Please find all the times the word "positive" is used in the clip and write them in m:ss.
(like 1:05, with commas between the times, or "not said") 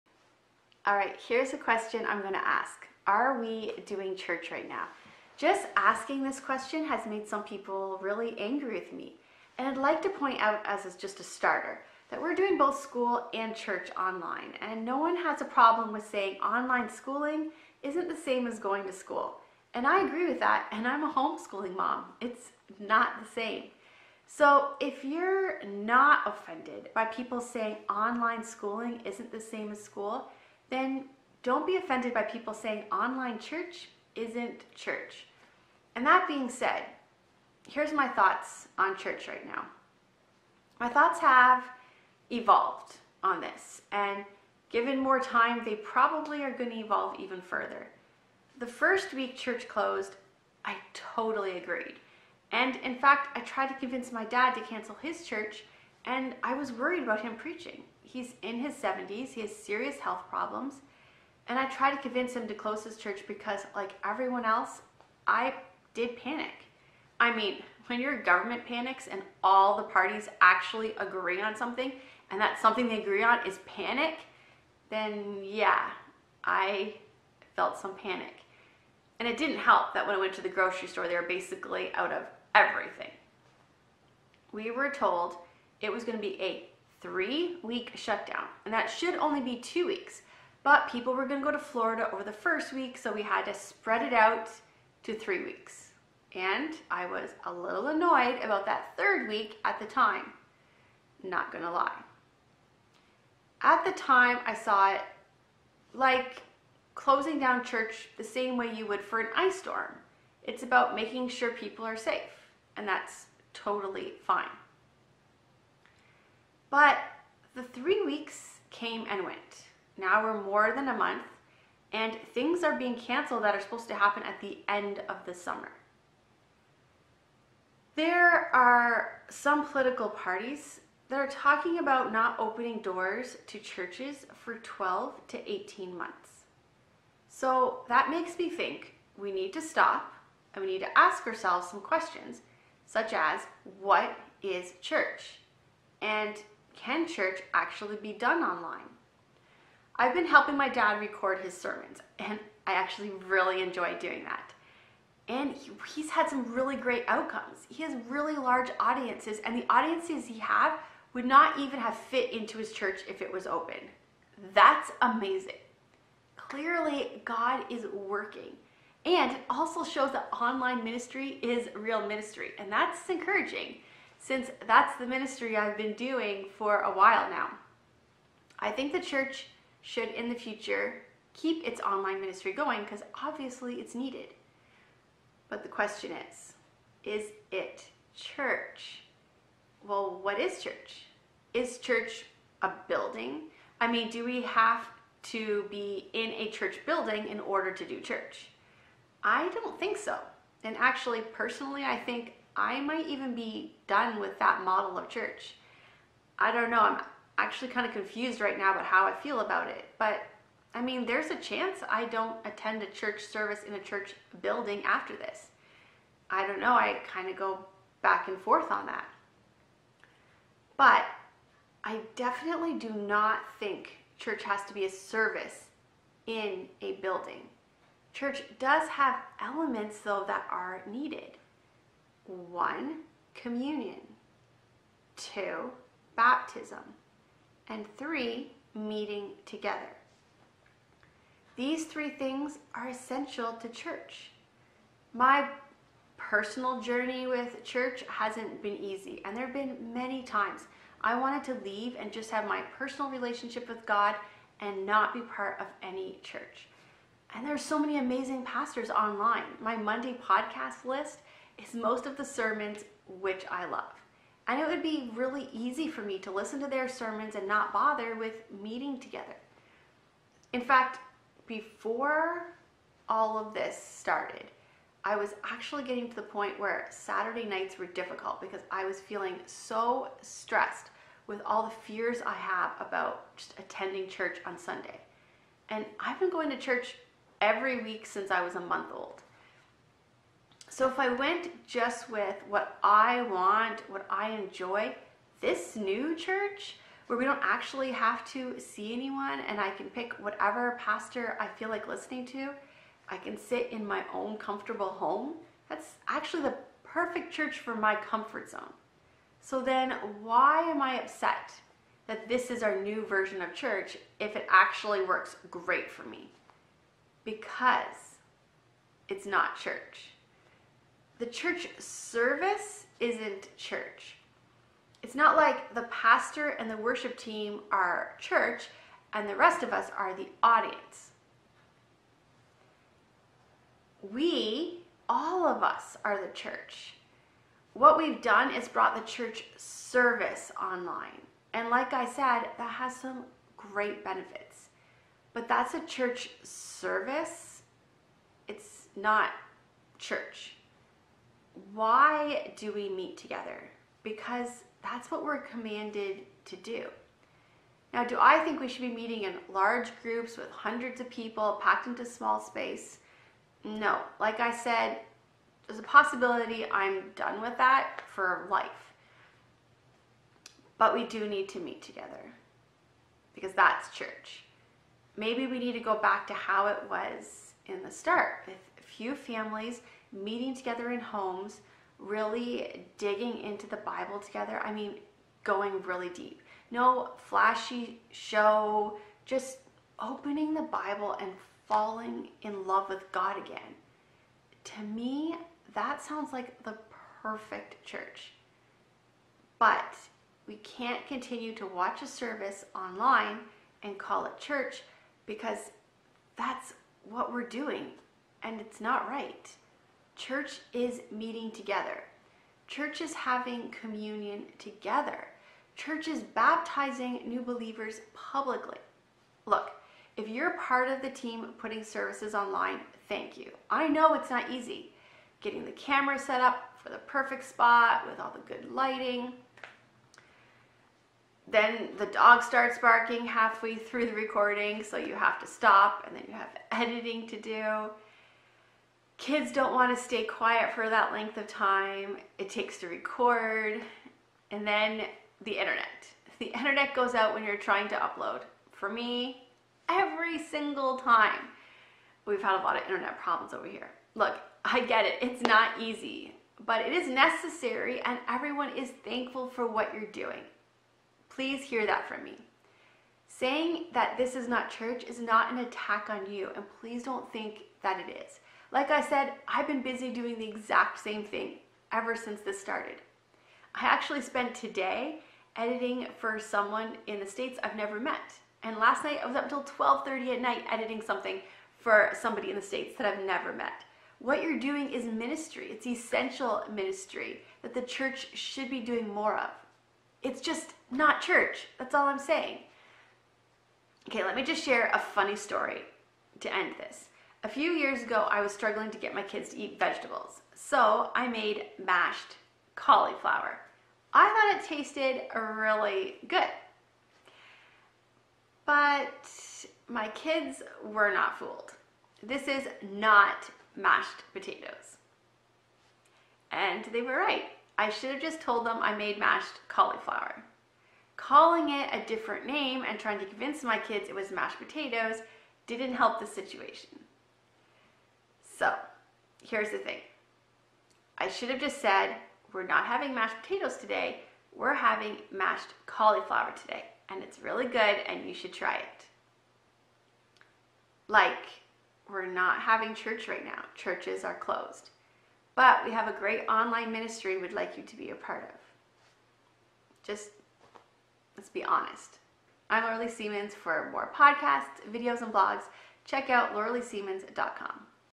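not said.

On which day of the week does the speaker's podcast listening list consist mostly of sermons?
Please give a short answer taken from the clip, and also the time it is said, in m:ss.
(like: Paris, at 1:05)
Monday, at 4:19.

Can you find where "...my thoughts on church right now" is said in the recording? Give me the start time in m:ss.
0:37.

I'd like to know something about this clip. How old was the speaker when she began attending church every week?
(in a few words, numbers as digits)
1 month.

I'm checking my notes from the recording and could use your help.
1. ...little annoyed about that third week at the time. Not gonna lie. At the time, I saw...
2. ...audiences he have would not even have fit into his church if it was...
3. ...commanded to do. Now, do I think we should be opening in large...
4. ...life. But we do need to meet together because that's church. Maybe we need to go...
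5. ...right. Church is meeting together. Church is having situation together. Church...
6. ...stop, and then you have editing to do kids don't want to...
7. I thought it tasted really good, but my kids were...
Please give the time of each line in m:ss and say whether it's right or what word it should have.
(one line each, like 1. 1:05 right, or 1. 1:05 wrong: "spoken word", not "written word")
1. 1:37 right
2. 2:39 right
3. 5:55 wrong: "meeting", not "opening"
4. 6:08 right
5. 6:49 wrong: "communion", not "situation"
6. 7:15 right
7. 8:24 right.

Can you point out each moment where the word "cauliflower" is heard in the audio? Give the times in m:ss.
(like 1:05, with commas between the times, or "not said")
8:22, 8:39, 8:55.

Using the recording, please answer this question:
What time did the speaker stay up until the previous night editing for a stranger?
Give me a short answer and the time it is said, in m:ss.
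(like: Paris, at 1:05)
12:30, at 7:59.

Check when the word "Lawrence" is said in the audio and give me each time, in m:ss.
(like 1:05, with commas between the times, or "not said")
not said.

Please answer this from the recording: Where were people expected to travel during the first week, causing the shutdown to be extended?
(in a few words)
Florida.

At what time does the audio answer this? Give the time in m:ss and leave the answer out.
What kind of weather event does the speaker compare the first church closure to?
1:49.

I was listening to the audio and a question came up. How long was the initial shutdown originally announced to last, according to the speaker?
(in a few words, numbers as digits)
3 weeks.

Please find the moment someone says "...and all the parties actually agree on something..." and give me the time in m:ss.
1:09.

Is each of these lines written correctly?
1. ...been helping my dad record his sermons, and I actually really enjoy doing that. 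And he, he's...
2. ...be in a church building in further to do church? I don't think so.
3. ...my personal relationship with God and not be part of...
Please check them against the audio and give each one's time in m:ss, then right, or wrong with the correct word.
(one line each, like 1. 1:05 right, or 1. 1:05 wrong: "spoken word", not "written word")
1. 2:30 right
2. 3:15 wrong: "order", not "further"
3. 4:12 right.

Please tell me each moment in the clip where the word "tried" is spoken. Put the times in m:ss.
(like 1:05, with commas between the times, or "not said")
0:53, 1:01.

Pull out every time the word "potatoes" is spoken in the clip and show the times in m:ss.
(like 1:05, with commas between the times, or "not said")
8:34, 8:44, 8:53.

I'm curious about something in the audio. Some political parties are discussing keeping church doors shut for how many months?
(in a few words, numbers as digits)
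12 to 18 months.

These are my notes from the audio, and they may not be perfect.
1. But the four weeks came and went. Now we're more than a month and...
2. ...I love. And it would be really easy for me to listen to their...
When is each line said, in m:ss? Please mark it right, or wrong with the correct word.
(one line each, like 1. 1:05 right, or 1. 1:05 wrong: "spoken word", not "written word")
1. 1:56 wrong: "three", not "four"
2. 4:23 right.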